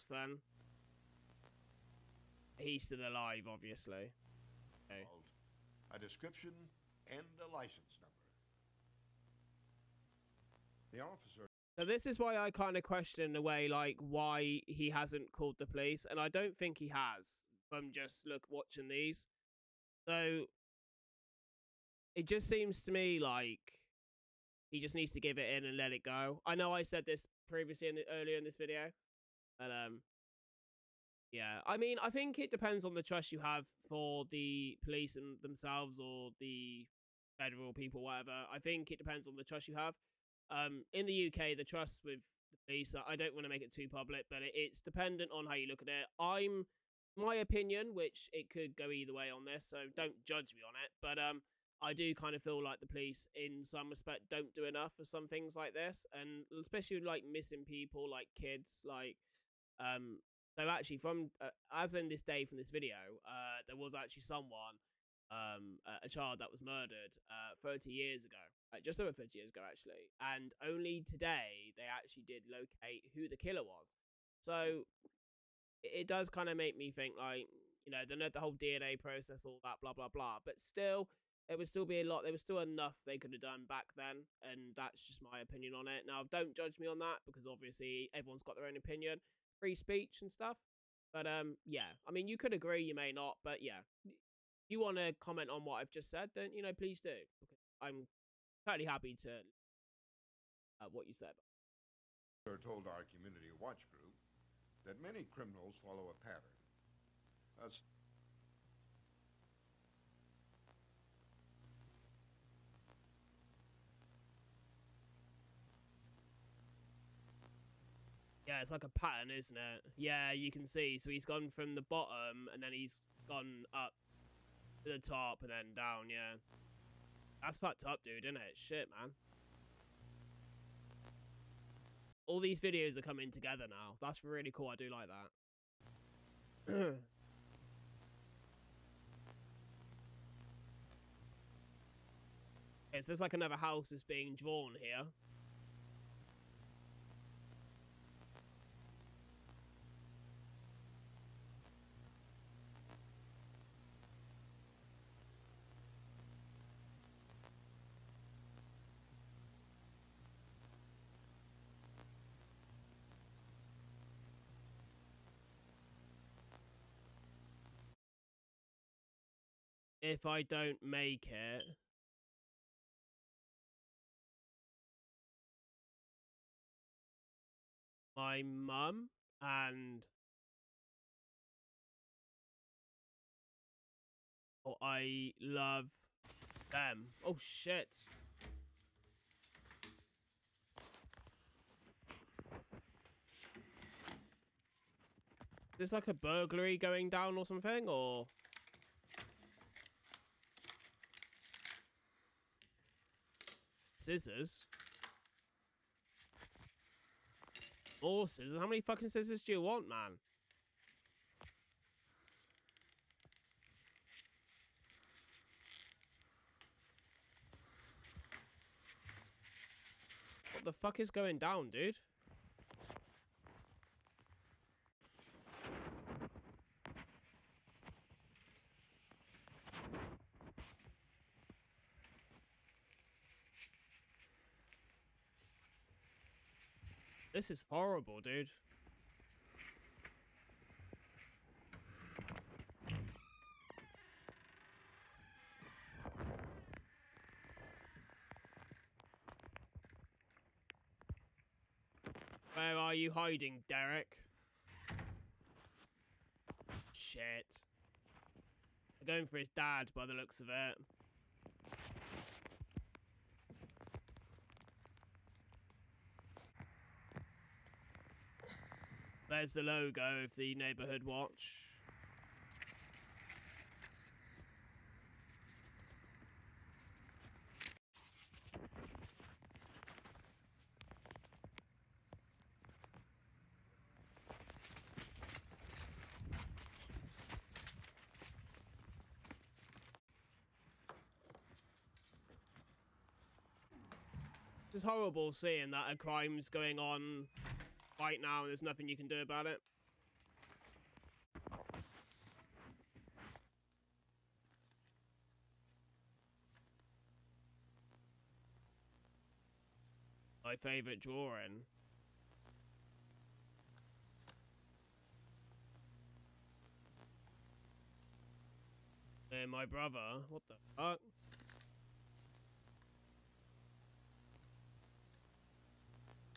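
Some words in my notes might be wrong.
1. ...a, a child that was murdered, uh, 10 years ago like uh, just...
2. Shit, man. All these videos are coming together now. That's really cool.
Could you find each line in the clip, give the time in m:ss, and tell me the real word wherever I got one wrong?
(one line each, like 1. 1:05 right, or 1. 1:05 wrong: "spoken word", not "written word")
1. 1:05 wrong: "30", not "10"
2. 2:08 right.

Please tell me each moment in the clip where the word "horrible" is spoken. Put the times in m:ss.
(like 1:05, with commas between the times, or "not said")
3:57, 4:54.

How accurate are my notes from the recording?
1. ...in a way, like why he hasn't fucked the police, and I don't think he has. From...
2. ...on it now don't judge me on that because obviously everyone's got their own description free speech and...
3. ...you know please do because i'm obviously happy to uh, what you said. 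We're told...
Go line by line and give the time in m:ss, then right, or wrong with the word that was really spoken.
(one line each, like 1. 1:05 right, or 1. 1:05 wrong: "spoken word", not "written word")
1. 0:13 wrong: "called", not "fucked"
2. 1:25 wrong: "opinion", not "description"
3. 1:36 wrong: "totally", not "obviously".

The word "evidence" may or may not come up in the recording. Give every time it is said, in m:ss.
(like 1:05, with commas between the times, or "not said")
not said.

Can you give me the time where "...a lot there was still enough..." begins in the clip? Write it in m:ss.
1:22.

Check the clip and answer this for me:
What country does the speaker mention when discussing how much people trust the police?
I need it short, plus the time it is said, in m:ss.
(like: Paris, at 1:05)
UK, at 0:41.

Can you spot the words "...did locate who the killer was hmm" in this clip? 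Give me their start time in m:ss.
1:12.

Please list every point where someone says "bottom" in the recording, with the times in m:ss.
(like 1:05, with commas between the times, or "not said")
2:01.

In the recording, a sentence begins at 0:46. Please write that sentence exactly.
I'm my opinion, which it could go either way on this, so don't judge me on it.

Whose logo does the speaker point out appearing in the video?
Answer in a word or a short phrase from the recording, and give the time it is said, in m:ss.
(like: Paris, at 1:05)
Neighbourhood Watch, at 4:30.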